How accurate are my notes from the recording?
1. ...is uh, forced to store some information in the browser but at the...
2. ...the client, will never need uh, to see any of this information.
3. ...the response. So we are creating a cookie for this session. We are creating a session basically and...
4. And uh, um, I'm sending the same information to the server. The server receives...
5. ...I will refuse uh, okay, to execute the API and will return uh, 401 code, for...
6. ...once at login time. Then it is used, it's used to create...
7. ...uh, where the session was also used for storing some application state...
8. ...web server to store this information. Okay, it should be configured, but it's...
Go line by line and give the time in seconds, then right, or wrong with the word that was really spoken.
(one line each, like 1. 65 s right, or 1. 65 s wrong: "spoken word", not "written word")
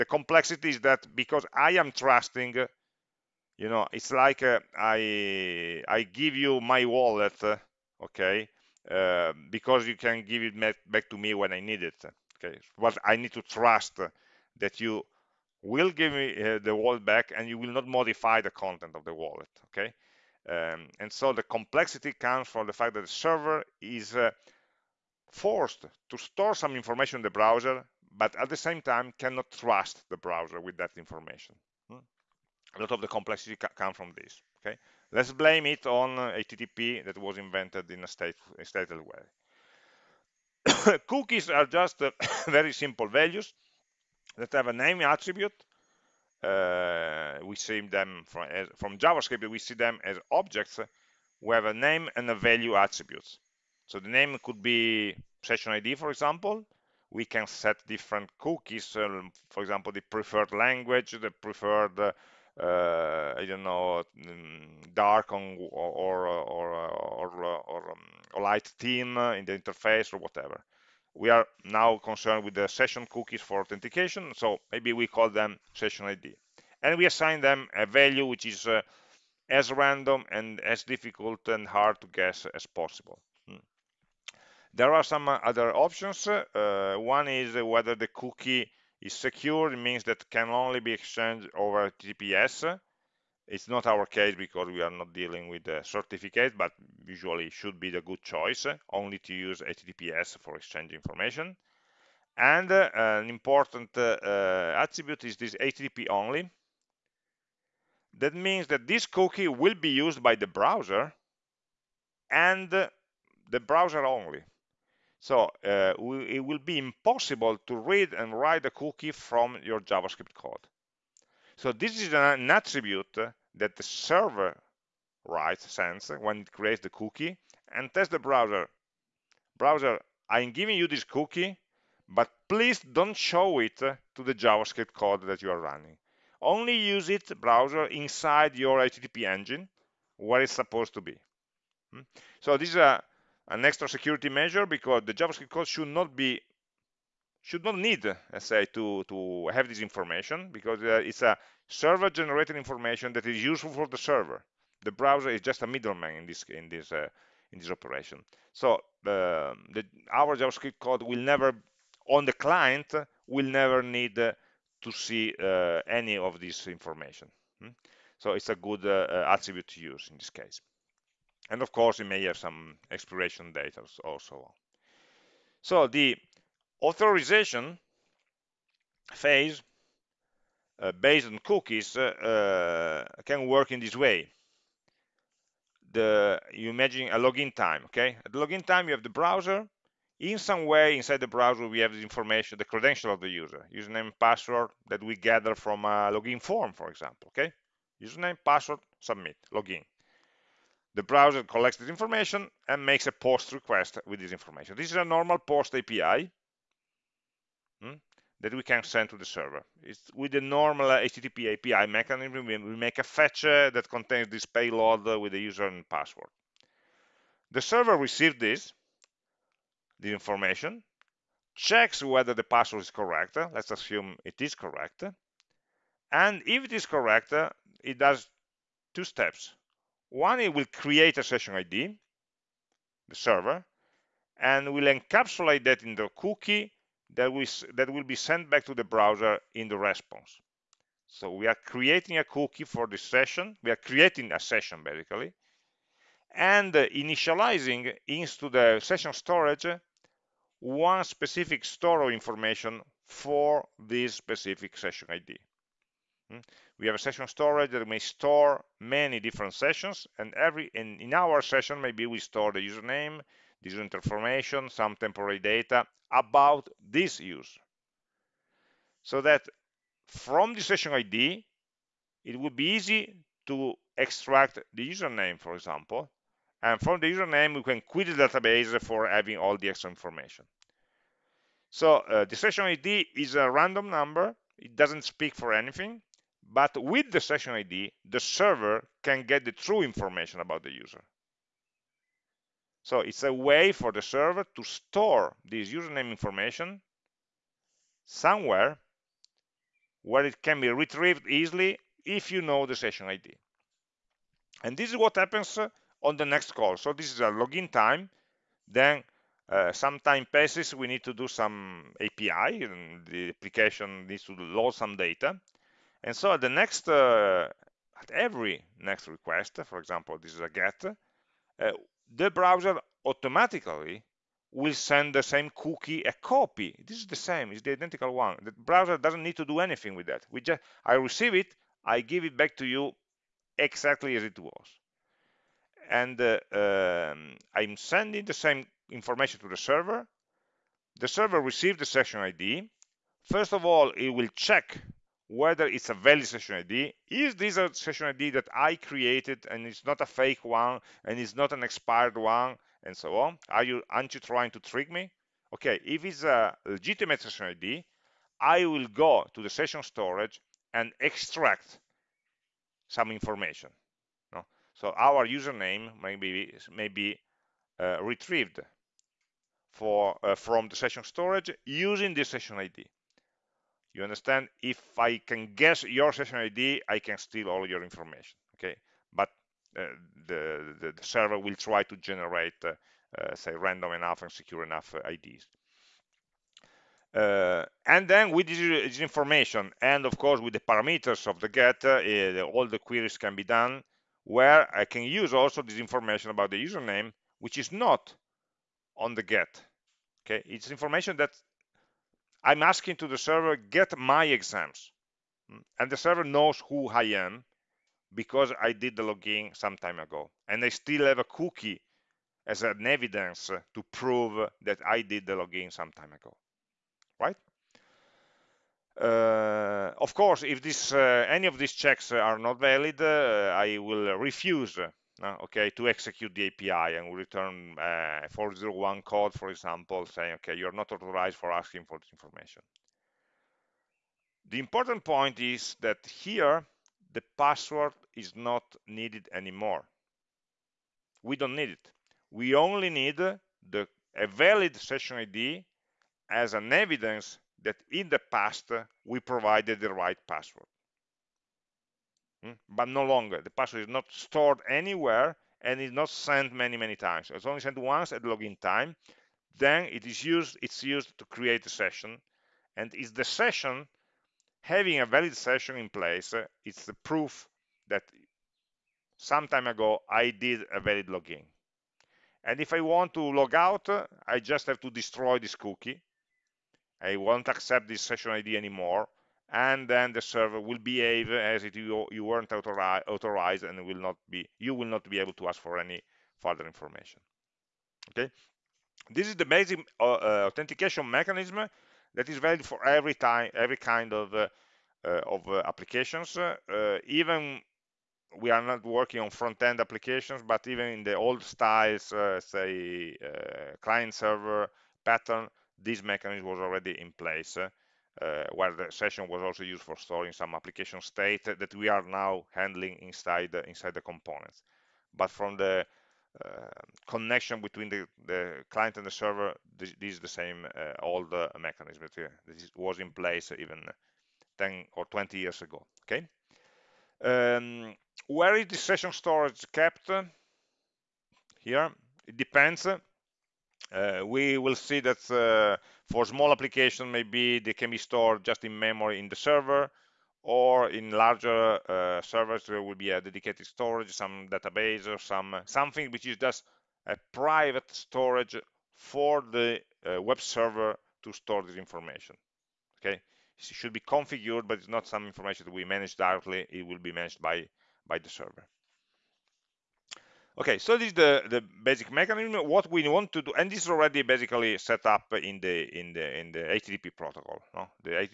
1. 23 s right
2. 162 s right
3. 239 s right
4. 335 s right
5. 423 s right
6. 457 s right
7. 508 s right
8. 550 s right.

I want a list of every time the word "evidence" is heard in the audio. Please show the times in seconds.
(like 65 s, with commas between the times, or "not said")
412 s, 446 s.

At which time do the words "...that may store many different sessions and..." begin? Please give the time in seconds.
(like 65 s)
257 s.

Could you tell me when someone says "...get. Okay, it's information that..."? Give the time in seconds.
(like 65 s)
399 s.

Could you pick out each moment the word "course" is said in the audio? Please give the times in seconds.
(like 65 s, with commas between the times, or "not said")
171 s, 390 s, 420 s.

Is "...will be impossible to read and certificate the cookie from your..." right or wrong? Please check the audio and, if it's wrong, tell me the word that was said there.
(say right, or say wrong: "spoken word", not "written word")
wrong: "write", not "certificate".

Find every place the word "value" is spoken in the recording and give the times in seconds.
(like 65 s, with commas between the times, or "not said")
43 s, 52 s, 77 s.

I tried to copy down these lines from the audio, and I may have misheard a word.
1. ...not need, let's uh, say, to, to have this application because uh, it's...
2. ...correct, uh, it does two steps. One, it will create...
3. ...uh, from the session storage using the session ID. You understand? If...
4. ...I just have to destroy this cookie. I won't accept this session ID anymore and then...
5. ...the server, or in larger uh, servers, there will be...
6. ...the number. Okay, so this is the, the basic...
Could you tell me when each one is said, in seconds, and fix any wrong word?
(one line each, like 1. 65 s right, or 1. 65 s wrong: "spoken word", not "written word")
1. 147 s wrong: "information", not "application"
2. 226 s right
3. 370 s right
4. 474 s right
5. 539 s right
6. 558 s wrong: "server", not "number".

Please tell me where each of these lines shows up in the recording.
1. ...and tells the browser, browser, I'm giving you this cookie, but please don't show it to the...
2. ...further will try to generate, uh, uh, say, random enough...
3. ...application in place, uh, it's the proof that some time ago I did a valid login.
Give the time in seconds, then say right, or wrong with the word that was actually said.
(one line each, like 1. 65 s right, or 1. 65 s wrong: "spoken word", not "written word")
1. 127 s right
2. 381 s wrong: "server", not "further"
3. 465 s wrong: "session", not "application".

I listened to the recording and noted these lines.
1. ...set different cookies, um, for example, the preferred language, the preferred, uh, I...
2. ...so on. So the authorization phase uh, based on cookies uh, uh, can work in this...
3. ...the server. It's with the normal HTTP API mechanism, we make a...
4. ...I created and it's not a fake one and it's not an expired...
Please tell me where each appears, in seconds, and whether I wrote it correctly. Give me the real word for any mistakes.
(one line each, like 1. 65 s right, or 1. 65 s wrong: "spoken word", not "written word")
1. 57 s right
2. 174 s right
3. 209 s right
4. 348 s right.